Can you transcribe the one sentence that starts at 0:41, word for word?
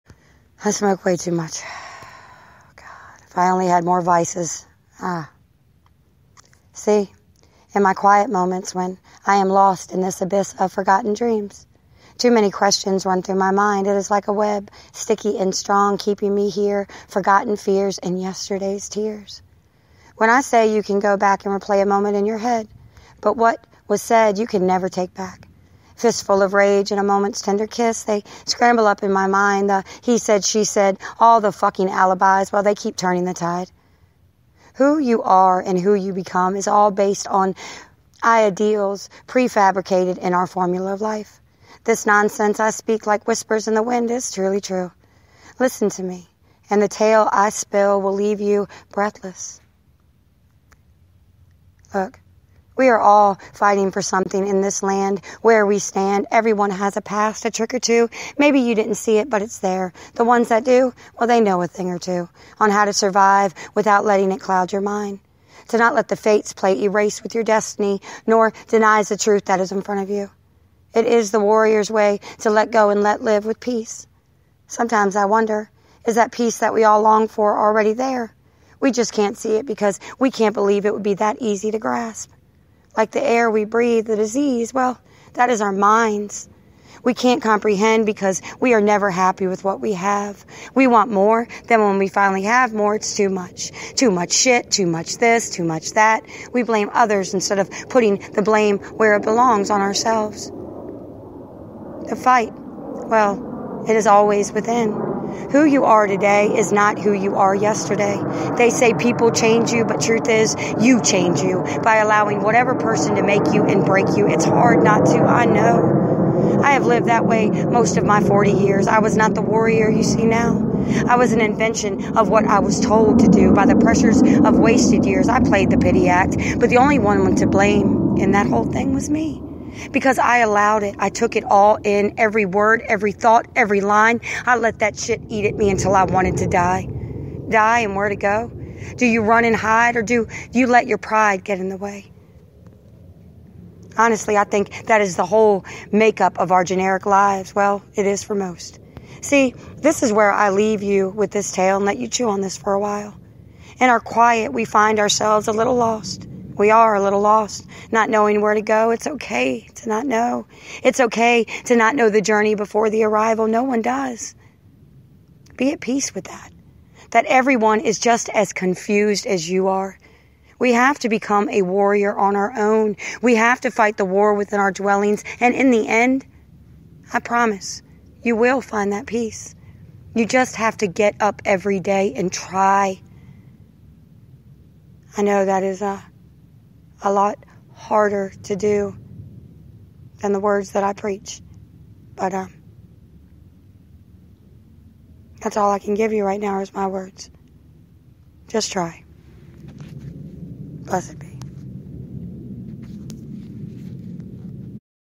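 This nonsense I speak like whispers in the wind is truly true.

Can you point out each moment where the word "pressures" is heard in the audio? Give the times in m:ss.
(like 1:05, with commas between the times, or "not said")
2:03.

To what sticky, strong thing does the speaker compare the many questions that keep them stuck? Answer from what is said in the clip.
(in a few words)
A web.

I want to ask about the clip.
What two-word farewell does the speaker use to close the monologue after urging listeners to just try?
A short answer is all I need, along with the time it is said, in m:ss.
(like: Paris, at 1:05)
Blessed be, at 3:20.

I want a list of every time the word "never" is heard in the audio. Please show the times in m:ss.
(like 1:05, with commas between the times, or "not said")
0:24, 1:28.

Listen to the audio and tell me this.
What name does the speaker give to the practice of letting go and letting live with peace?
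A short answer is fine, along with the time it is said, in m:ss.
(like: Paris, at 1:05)
The warrior's way, at 1:11.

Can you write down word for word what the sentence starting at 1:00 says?
The ones that do, well, they know a thing or two on how to survive without letting it cloud your mind.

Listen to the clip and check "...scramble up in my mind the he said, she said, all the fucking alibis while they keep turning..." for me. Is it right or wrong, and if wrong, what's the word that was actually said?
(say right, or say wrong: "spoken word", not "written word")
right.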